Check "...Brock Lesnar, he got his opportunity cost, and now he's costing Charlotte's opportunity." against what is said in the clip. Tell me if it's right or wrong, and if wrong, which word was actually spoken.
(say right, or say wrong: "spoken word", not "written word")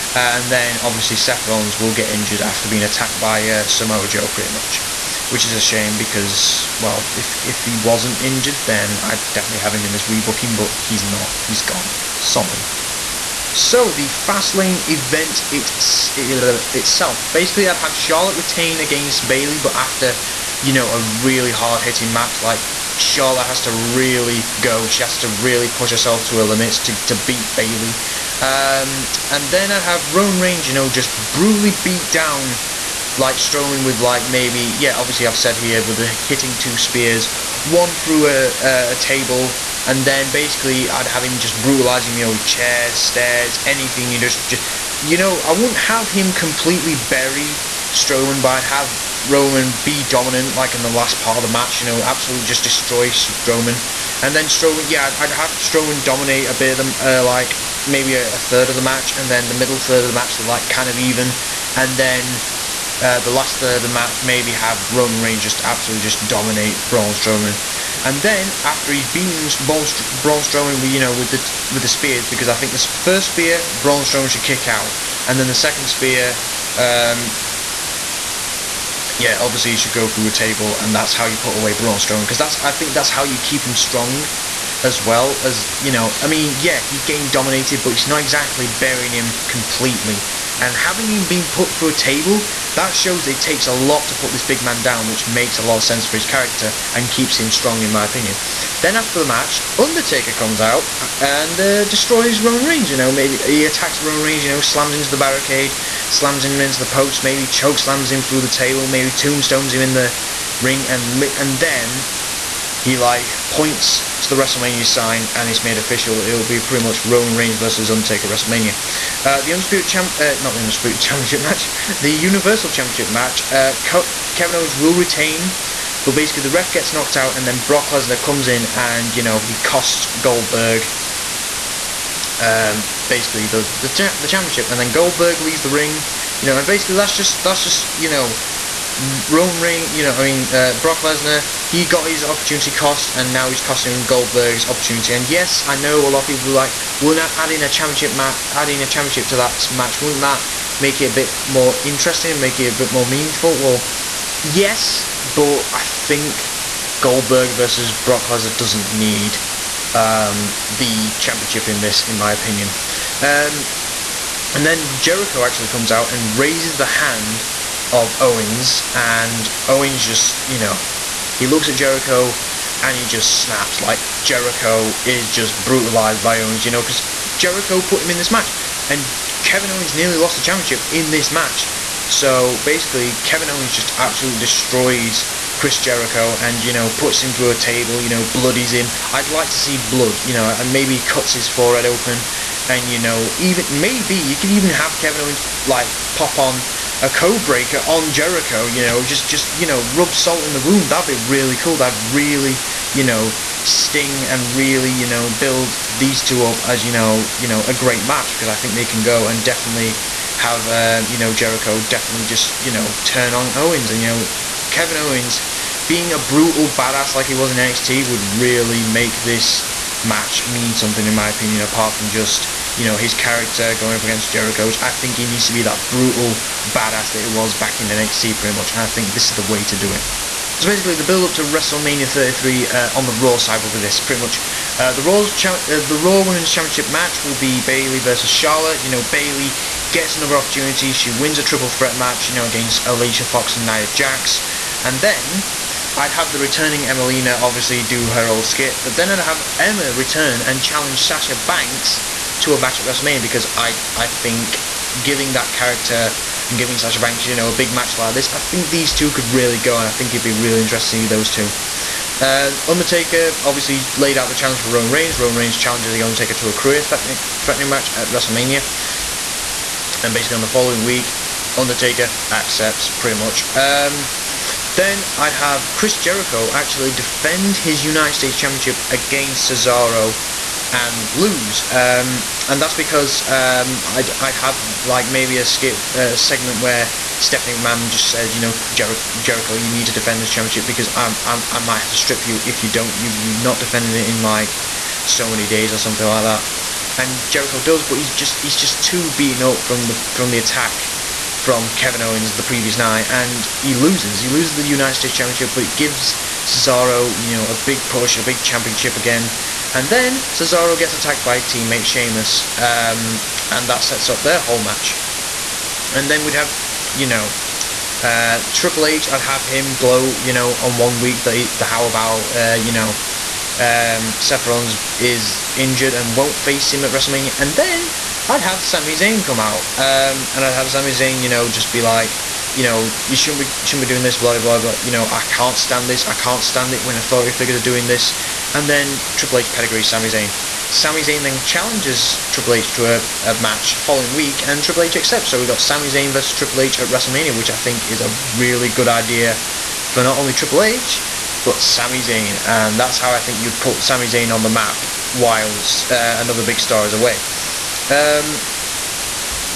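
wrong: "Goldberg", not "Charlotte".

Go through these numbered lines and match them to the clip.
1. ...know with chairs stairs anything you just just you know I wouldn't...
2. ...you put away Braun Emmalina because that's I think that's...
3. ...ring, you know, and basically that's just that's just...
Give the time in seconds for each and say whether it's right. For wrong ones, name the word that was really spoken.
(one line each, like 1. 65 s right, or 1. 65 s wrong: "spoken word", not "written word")
1. 42 s right
2. 81 s wrong: "Strowman", not "Emmalina"
3. 135 s right.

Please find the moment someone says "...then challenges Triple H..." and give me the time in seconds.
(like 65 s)
341 s.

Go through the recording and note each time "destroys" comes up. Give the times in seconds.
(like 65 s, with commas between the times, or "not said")
52 s, 101 s, 184 s.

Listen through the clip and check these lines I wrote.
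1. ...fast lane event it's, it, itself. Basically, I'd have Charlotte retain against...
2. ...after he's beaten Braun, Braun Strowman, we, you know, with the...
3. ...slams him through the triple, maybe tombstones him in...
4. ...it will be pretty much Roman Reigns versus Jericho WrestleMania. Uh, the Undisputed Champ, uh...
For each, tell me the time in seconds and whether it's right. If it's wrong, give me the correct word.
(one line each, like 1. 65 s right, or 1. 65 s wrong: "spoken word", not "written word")
1. 14 s right
2. 68 s right
3. 107 s wrong: "table", not "triple"
4. 116 s wrong: "Undertaker", not "Jericho".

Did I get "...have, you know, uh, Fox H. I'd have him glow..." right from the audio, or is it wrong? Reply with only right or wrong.
wrong.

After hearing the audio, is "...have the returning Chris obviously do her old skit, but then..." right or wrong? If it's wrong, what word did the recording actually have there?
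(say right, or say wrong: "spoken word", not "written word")
wrong: "Emmalina", not "Chris".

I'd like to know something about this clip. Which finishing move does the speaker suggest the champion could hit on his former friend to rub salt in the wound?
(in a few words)
Code Breaker.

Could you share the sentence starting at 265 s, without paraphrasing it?
Roman Reigns challenges the Undertaker to a career threatening, threatening match at WrestleMania.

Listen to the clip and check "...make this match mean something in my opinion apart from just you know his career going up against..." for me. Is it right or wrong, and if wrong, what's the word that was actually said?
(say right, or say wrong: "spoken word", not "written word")
wrong: "character", not "career".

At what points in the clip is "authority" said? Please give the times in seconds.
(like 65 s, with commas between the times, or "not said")
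336 s.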